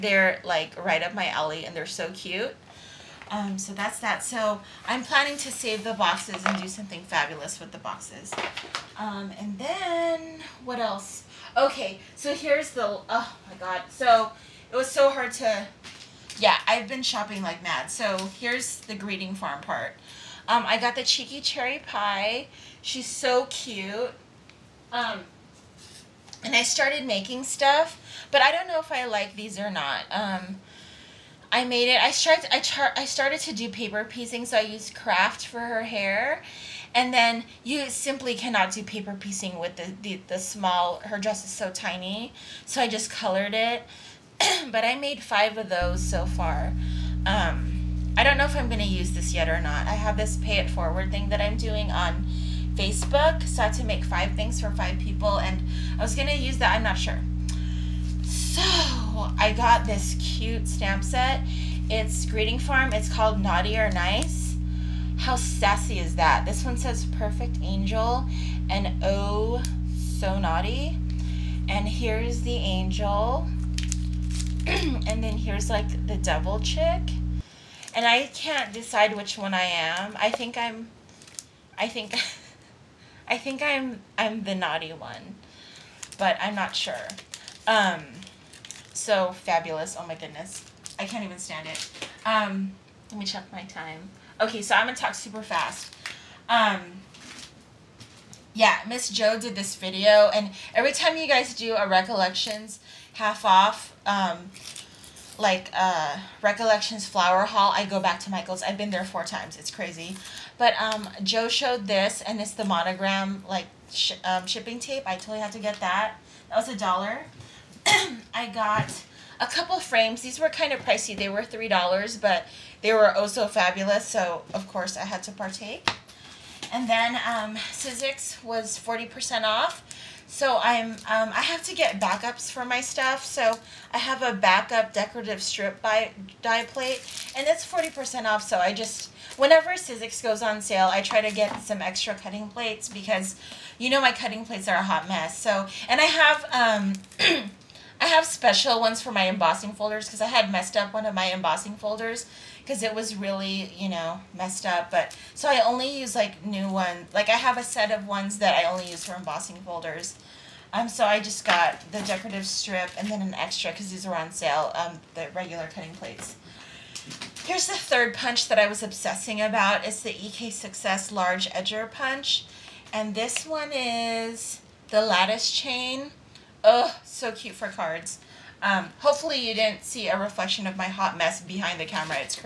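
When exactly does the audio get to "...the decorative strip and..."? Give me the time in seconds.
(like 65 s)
161 s.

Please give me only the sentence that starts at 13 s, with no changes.
So it was so hard to, yeah, I've been shopping like mad.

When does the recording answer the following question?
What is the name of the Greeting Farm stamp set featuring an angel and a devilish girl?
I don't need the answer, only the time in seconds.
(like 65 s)
63 s.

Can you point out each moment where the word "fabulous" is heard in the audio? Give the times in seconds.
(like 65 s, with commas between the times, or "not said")
7 s, 89 s, 123 s.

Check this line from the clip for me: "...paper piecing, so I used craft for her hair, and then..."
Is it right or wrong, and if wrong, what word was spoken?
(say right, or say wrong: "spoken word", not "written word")
right.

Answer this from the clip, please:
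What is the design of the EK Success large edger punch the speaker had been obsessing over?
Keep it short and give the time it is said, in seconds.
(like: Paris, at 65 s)
lattice chain, at 175 s.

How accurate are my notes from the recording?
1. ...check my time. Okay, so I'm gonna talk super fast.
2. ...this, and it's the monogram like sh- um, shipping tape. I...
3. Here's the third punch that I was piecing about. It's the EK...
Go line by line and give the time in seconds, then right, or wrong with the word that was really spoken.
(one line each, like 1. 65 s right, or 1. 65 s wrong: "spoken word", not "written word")
1. 93 s right
2. 111 s right
3. 167 s wrong: "obsessing", not "piecing".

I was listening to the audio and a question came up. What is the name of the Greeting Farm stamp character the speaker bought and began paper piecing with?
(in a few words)
Cheeky Cherry Pie.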